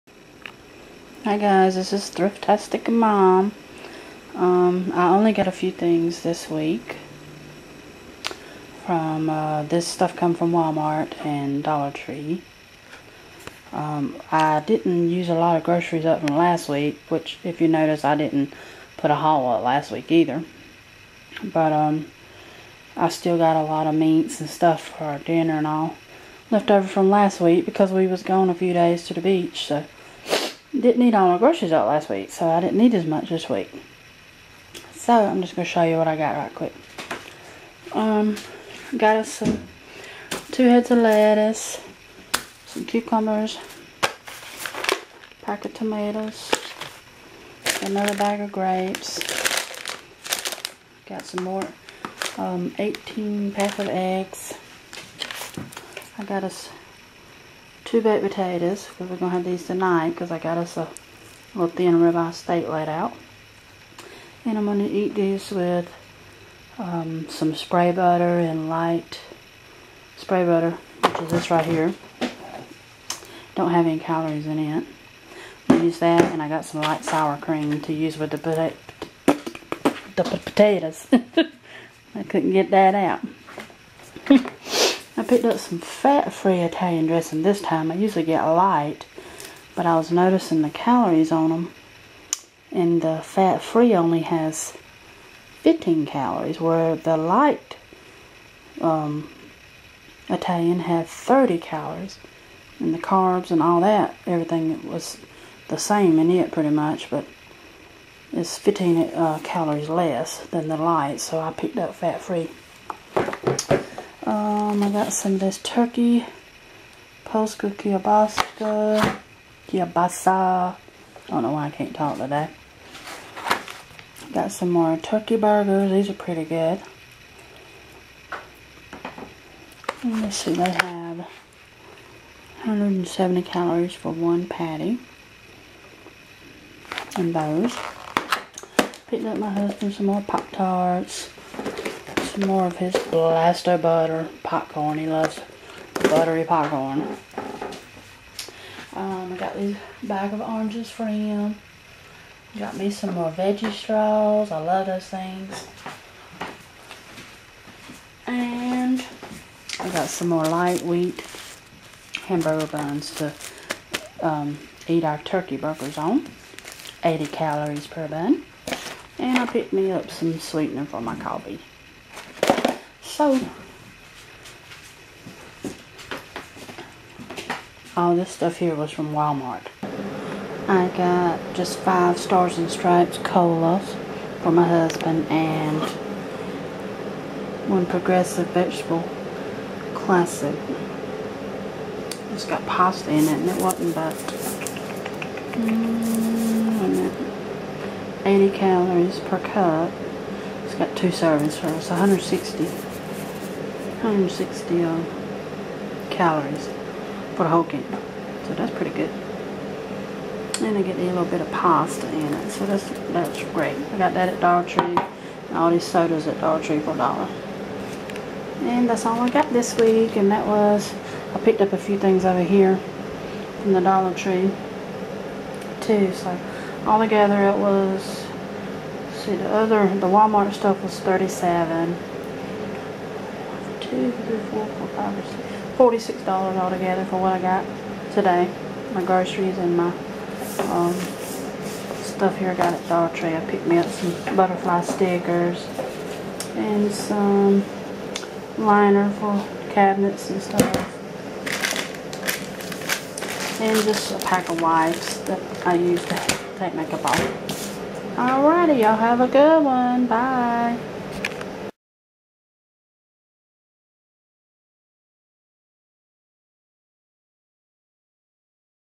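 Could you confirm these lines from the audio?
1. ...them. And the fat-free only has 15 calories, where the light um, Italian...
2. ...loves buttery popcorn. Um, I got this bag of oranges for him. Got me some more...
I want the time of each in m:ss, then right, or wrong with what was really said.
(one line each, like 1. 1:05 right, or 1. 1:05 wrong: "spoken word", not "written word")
1. 1:31 right
2. 2:25 right.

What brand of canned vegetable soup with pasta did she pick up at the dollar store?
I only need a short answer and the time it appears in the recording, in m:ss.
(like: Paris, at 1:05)
Progresso, at 3:07.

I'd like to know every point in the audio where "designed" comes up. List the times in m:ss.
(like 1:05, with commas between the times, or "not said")
not said.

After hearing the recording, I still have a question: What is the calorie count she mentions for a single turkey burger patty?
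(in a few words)
170.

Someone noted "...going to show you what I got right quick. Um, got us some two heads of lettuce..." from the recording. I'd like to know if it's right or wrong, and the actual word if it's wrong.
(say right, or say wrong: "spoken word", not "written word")
right.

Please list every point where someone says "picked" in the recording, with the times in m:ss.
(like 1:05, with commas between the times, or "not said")
1:25, 1:51, 2:19, 2:49, 3:41, 4:03.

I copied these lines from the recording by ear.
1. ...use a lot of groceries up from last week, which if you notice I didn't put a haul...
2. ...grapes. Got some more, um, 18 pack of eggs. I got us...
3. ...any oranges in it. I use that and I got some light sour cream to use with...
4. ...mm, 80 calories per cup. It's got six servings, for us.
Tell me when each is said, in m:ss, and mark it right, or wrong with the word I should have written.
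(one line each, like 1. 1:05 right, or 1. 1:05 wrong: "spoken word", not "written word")
1. 0:15 right
2. 0:48 right
3. 1:13 wrong: "calories", not "oranges"
4. 3:15 wrong: "two", not "six".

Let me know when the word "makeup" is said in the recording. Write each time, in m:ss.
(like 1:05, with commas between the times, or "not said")
4:16.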